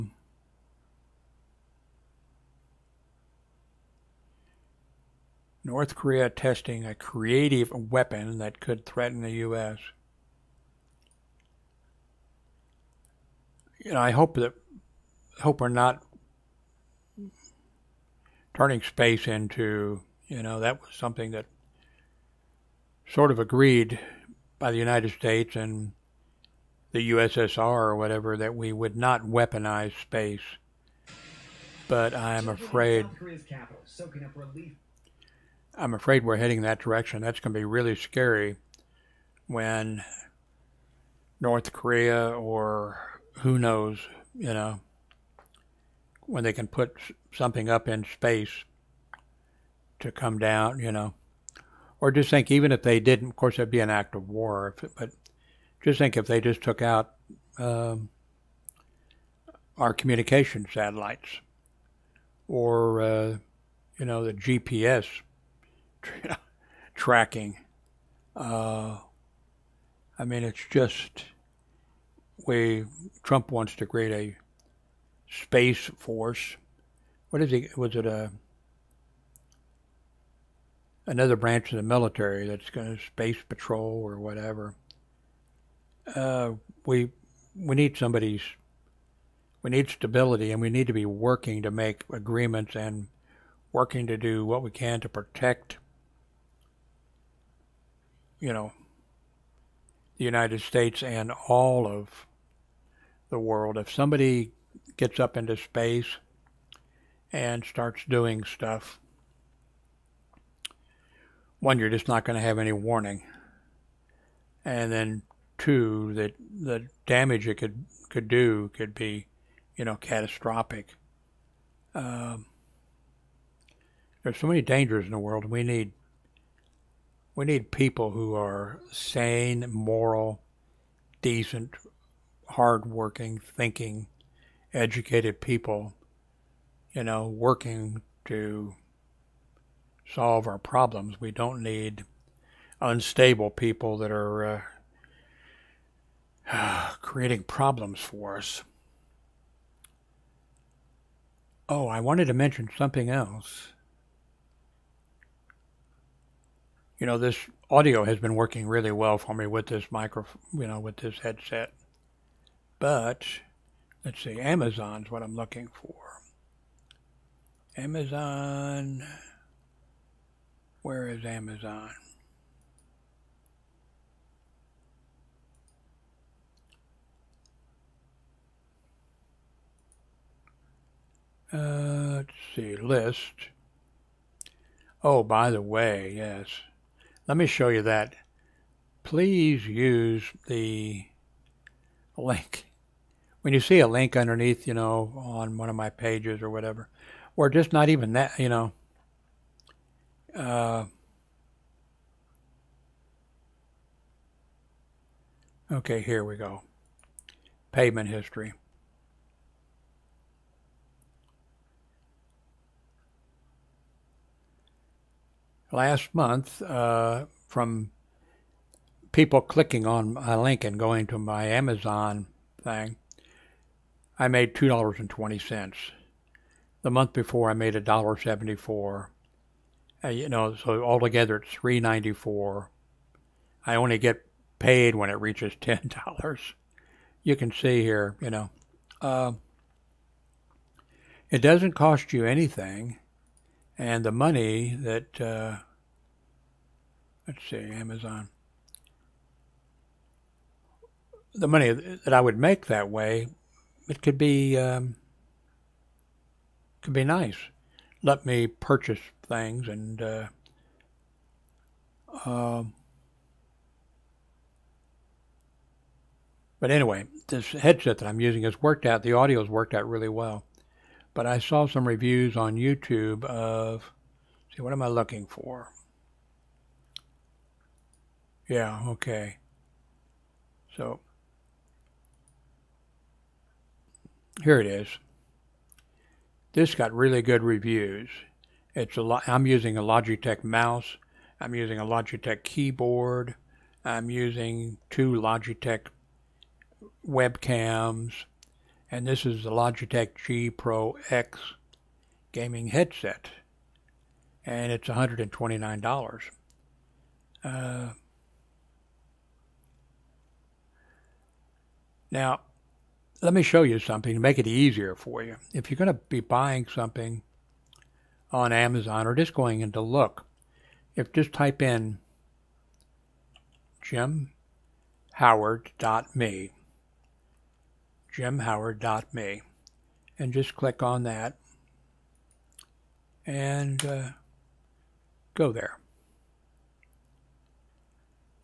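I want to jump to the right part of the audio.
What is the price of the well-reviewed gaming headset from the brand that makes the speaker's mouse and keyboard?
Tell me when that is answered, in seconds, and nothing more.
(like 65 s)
304 s.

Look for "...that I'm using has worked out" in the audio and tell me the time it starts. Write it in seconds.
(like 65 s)
267 s.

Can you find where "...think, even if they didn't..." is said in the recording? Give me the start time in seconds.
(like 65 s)
52 s.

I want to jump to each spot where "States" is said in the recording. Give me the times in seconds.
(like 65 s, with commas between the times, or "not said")
25 s, 100 s.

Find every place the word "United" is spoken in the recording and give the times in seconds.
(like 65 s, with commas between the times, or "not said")
24 s, 100 s.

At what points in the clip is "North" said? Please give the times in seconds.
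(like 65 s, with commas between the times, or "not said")
5 s, 41 s.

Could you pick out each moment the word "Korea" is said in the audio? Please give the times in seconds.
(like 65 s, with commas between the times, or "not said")
5 s, 41 s.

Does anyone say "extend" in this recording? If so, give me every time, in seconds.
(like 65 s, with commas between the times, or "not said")
not said.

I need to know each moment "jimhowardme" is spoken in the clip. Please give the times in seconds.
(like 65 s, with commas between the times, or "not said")
323 s, 328 s.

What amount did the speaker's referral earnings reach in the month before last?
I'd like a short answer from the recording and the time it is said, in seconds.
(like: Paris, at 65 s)
$1.74, at 227 s.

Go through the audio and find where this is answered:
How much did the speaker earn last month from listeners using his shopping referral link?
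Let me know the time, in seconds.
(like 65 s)
224 s.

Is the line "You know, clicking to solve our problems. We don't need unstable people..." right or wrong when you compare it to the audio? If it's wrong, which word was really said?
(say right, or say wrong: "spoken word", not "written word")
wrong: "working", not "clicking".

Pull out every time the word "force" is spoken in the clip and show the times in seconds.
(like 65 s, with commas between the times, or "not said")
75 s.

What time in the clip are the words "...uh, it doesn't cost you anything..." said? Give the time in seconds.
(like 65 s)
239 s.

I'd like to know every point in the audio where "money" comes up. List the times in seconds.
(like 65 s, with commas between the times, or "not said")
244 s, 251 s.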